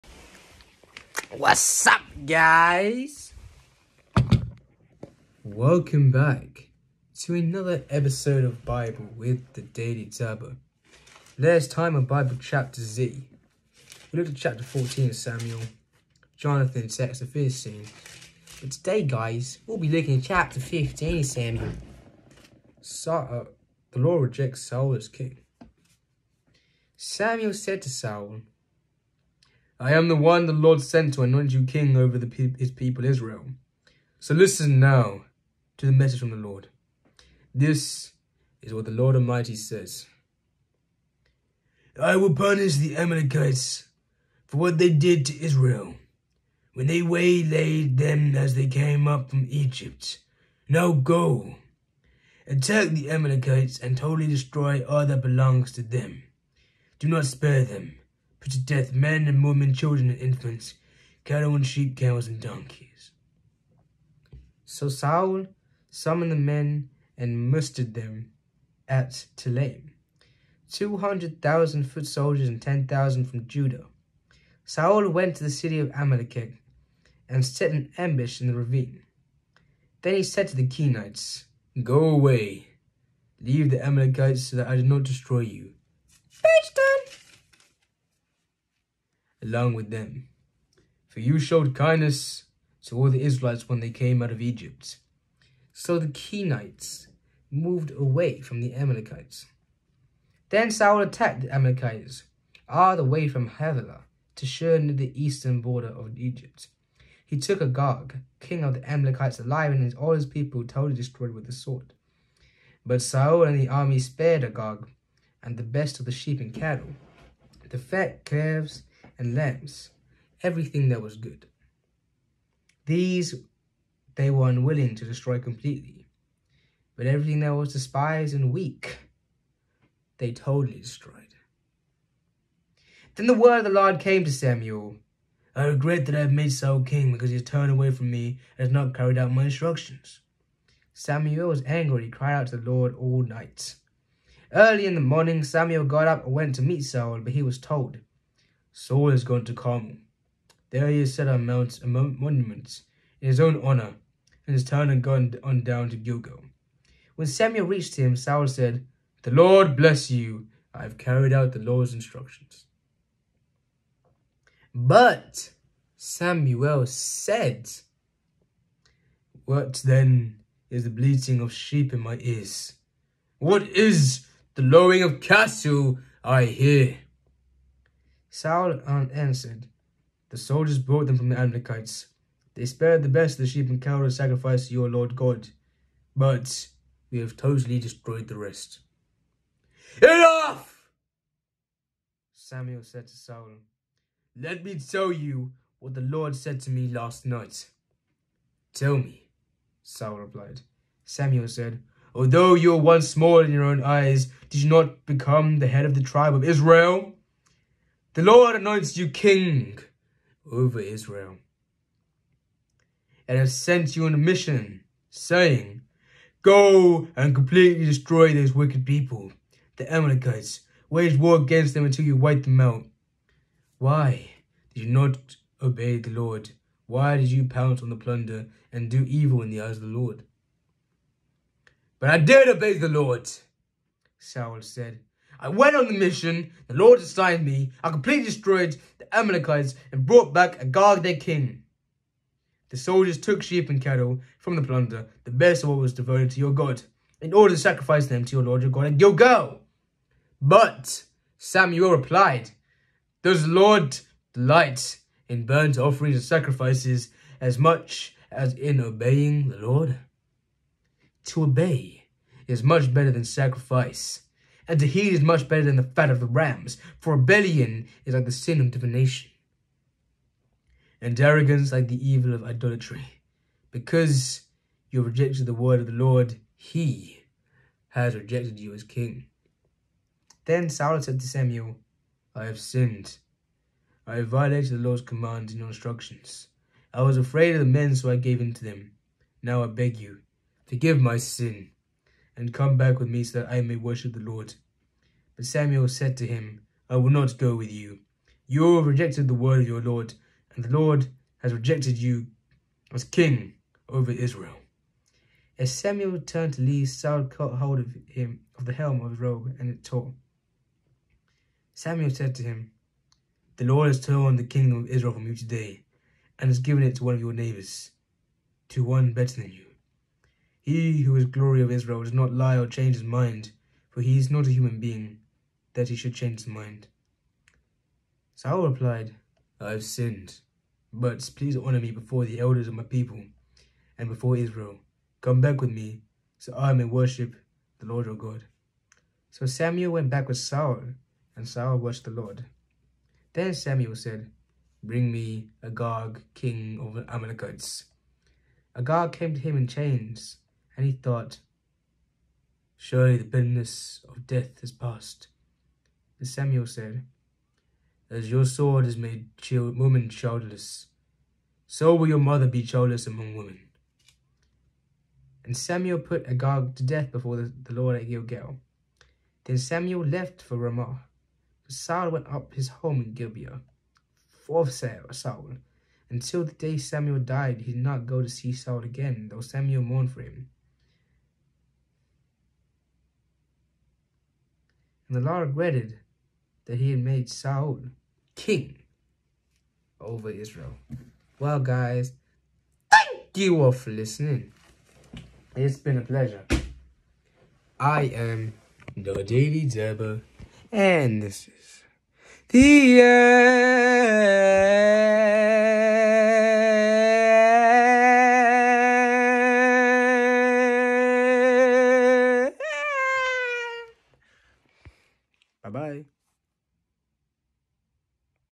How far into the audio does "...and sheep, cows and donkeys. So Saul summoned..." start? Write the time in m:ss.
1:01.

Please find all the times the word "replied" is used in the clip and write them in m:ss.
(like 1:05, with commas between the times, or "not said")
3:20, 4:11, 5:28.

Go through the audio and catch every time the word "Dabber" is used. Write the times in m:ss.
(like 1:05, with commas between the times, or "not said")
0:10, 6:39.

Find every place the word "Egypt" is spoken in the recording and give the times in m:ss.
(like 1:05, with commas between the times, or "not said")
0:49, 1:34, 1:46.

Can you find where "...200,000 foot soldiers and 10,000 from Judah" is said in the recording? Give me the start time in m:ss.
1:10.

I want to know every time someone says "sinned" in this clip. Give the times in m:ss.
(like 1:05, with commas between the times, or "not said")
4:42, 5:29.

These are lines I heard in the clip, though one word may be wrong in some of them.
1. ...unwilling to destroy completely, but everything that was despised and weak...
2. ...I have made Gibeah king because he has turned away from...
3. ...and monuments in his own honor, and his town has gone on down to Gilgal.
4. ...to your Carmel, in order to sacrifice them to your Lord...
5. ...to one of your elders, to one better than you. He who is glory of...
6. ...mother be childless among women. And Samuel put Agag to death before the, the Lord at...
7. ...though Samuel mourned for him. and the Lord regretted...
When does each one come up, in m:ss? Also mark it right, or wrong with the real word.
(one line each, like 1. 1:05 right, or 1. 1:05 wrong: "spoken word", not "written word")
1. 2:04 right
2. 2:16 wrong: "Saul", not "Gibeah"
3. 2:31 right
4. 4:06 wrong: "God", not "Carmel"
5. 5:16 wrong: "neighbors", not "elders"
6. 6:02 right
7. 6:19 right.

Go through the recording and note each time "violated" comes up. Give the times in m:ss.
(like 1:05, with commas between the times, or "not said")
4:44.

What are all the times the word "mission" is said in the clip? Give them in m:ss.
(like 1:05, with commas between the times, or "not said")
3:34, 3:55.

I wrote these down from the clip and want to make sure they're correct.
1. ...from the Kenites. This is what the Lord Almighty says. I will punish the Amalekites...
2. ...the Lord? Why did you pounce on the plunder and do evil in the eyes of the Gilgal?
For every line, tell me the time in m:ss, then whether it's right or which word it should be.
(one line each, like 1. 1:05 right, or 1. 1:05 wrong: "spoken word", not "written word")
1. 0:36 wrong: "Lord", not "Kenites"
2. 3:45 wrong: "Lord", not "Gilgal".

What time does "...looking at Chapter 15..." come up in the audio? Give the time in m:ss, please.
0:19.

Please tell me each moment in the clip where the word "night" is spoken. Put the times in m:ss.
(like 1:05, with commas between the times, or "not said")
2:23, 3:17.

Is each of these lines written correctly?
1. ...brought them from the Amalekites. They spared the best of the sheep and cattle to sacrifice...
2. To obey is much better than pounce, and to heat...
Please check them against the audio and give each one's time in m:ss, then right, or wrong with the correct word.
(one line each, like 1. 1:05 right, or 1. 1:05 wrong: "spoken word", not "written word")
1. 3:00 right
2. 4:21 wrong: "sacrifice", not "pounce".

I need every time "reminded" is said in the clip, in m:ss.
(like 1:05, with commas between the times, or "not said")
not said.